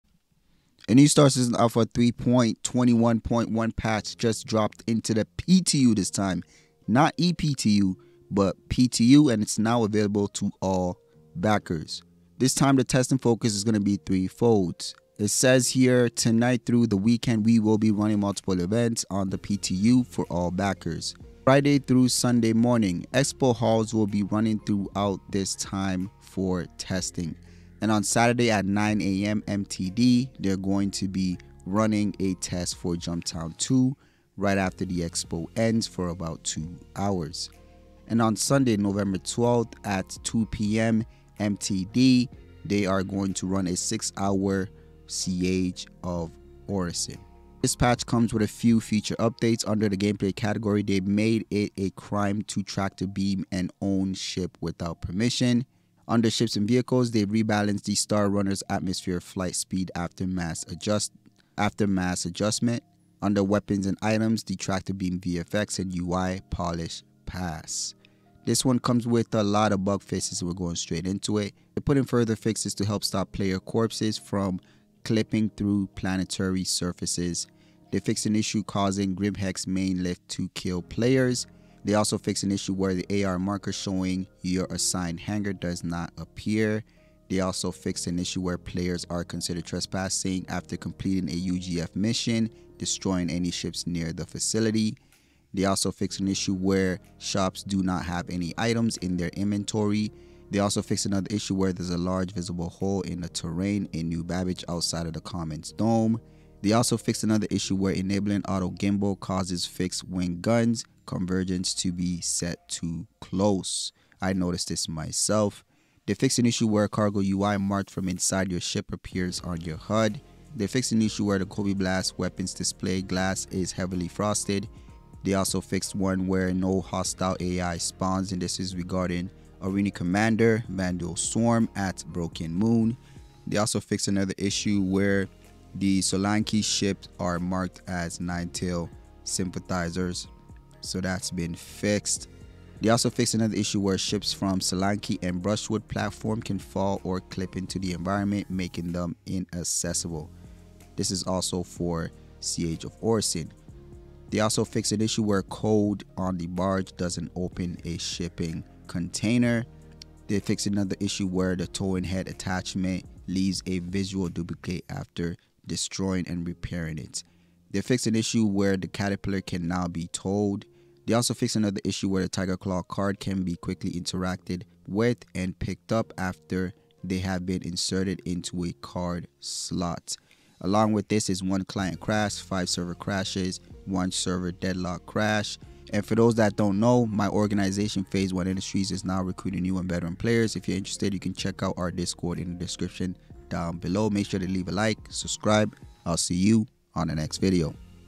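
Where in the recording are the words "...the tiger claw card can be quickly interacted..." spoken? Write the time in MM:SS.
02:52.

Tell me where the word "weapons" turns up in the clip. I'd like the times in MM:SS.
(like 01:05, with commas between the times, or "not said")
01:03, 02:02.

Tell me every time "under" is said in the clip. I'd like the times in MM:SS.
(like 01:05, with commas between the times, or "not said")
00:49, 01:03.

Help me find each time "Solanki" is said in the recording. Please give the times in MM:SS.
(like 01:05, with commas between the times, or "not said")
02:16, 02:24.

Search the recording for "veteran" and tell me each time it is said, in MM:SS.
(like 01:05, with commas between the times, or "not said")
03:09.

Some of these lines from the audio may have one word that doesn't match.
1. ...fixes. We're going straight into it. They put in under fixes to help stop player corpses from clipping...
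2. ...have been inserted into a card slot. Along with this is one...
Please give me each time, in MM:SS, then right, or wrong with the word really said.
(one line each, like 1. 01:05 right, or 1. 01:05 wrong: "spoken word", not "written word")
1. 01:10 wrong: "further", not "under"
2. 02:57 right.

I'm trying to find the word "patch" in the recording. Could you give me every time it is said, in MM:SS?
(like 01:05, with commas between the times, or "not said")
00:03, 00:47.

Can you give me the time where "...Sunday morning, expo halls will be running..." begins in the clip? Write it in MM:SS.
00:22.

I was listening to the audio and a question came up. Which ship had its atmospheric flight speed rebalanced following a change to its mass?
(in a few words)
Star Runner.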